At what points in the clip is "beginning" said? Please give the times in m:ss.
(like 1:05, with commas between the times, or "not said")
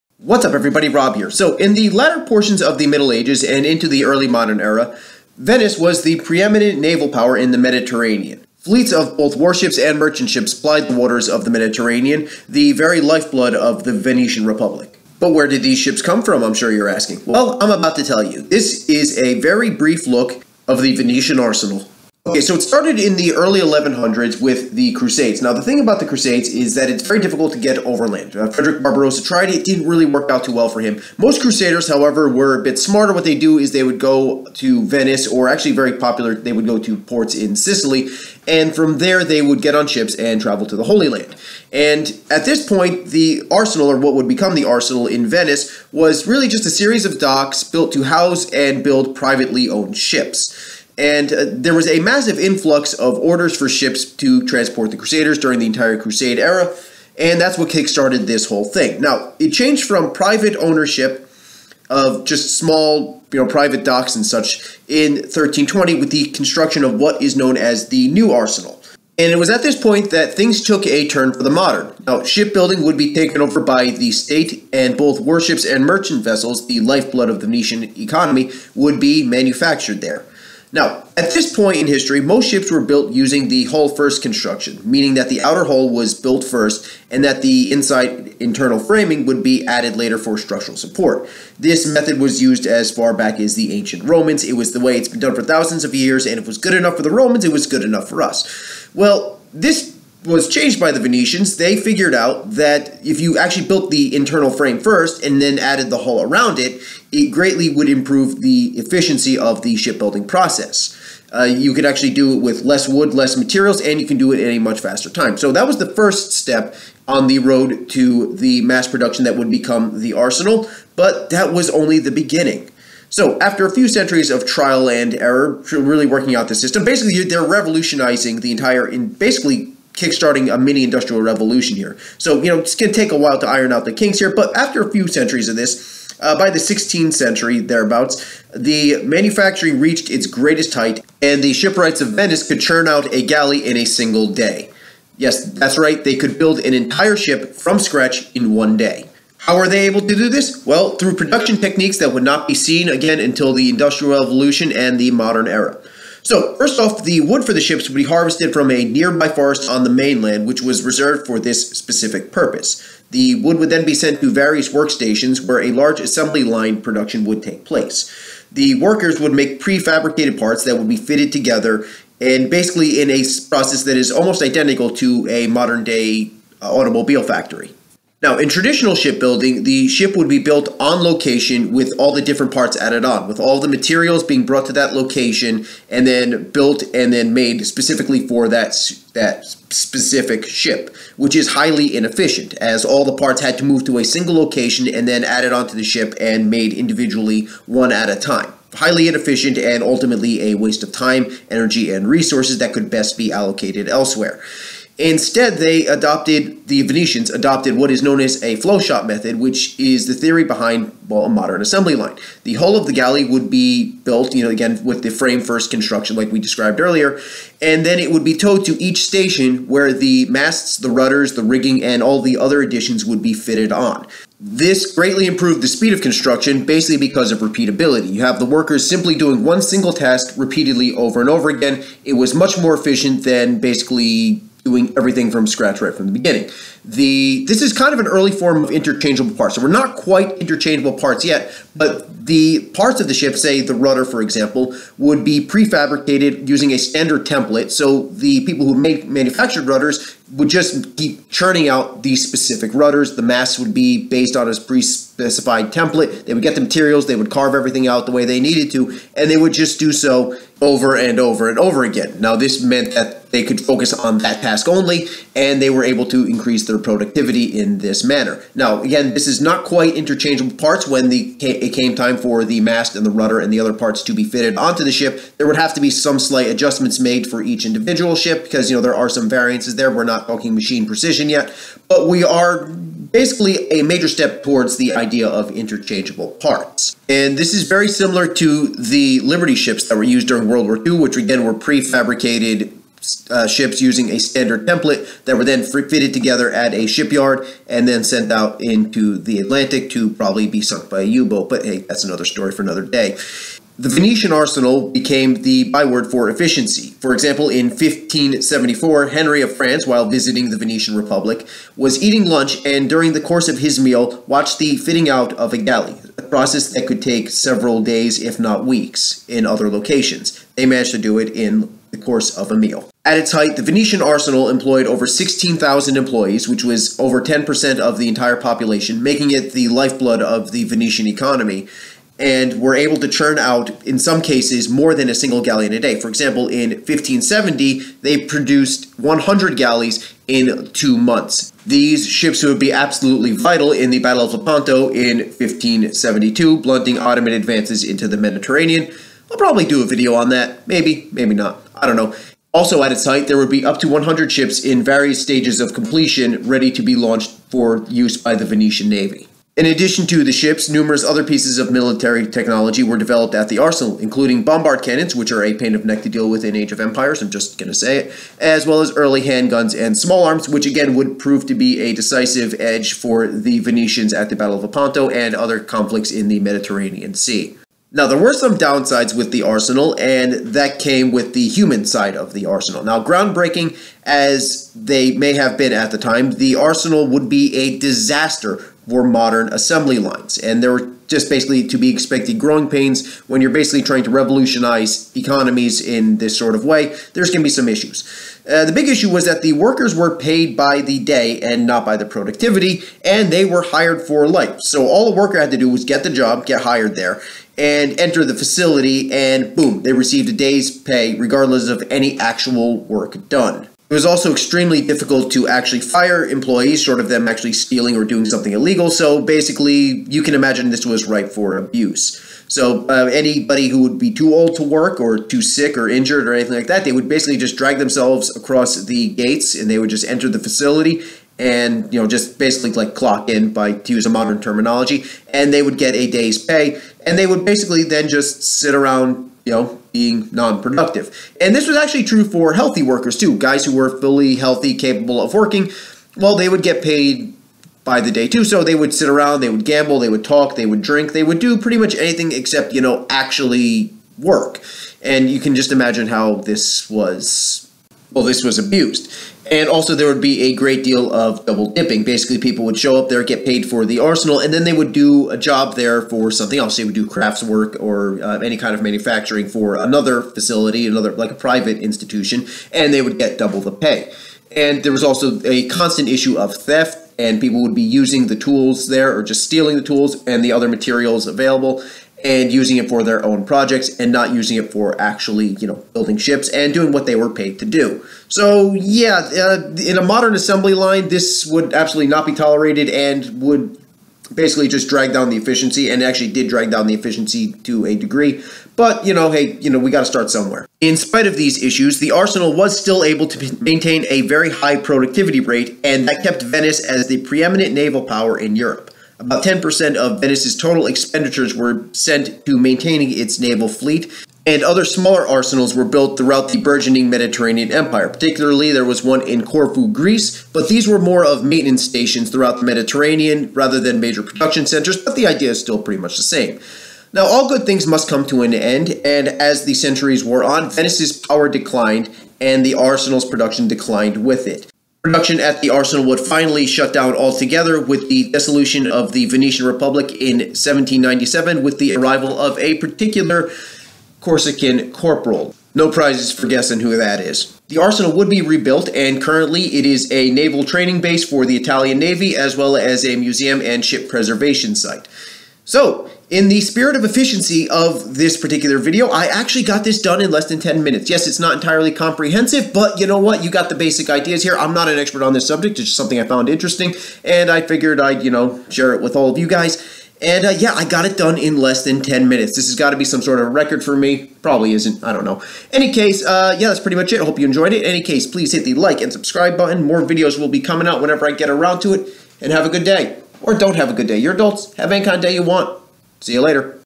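2:02, 3:56.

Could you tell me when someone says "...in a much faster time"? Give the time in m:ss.
1:54.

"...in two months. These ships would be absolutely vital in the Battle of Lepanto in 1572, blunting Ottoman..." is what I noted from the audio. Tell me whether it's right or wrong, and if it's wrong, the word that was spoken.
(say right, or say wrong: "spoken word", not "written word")
right.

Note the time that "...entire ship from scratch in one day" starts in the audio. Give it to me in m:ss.
2:26.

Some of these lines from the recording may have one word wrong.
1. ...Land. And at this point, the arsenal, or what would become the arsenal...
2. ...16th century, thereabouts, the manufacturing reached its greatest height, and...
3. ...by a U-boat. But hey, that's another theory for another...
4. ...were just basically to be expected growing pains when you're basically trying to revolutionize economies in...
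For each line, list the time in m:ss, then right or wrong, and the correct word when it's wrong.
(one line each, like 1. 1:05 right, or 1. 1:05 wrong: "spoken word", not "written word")
1. 0:41 right
2. 2:16 right
3. 5:00 wrong: "story", not "theory"
4. 6:30 right.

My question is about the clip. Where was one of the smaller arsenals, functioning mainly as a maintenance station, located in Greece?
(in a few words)
Corfu.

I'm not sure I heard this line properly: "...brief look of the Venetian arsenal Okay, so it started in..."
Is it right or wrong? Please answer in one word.
right.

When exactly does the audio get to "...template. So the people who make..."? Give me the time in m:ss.
4:07.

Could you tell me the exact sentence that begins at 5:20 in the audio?
They managed to do it in the course of a meal.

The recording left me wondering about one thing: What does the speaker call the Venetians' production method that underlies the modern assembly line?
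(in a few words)
flow shop method.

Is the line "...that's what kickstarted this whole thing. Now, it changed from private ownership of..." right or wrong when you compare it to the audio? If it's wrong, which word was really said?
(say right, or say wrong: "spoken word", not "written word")
right.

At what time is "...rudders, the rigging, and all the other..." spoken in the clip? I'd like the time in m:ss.
3:40.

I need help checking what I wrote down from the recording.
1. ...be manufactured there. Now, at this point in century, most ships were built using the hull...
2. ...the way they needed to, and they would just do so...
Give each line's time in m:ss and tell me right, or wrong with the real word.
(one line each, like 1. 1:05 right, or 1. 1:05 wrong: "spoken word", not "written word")
1. 1:18 wrong: "history", not "century"
2. 4:18 right.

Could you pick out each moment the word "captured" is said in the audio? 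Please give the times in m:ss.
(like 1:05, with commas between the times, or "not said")
not said.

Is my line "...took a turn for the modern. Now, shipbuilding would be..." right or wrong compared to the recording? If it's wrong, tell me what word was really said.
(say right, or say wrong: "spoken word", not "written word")
right.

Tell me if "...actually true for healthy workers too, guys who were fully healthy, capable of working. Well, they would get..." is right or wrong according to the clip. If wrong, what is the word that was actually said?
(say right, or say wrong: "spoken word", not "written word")
right.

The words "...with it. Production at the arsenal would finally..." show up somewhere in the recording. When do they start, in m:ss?
8:54.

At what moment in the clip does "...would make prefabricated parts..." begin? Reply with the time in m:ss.
2:49.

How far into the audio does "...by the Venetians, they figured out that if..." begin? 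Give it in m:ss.
1:40.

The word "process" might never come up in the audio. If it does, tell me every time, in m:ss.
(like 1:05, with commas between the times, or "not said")
1:50, 2:53, 5:16.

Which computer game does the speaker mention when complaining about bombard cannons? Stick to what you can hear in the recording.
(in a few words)
Age of Empires.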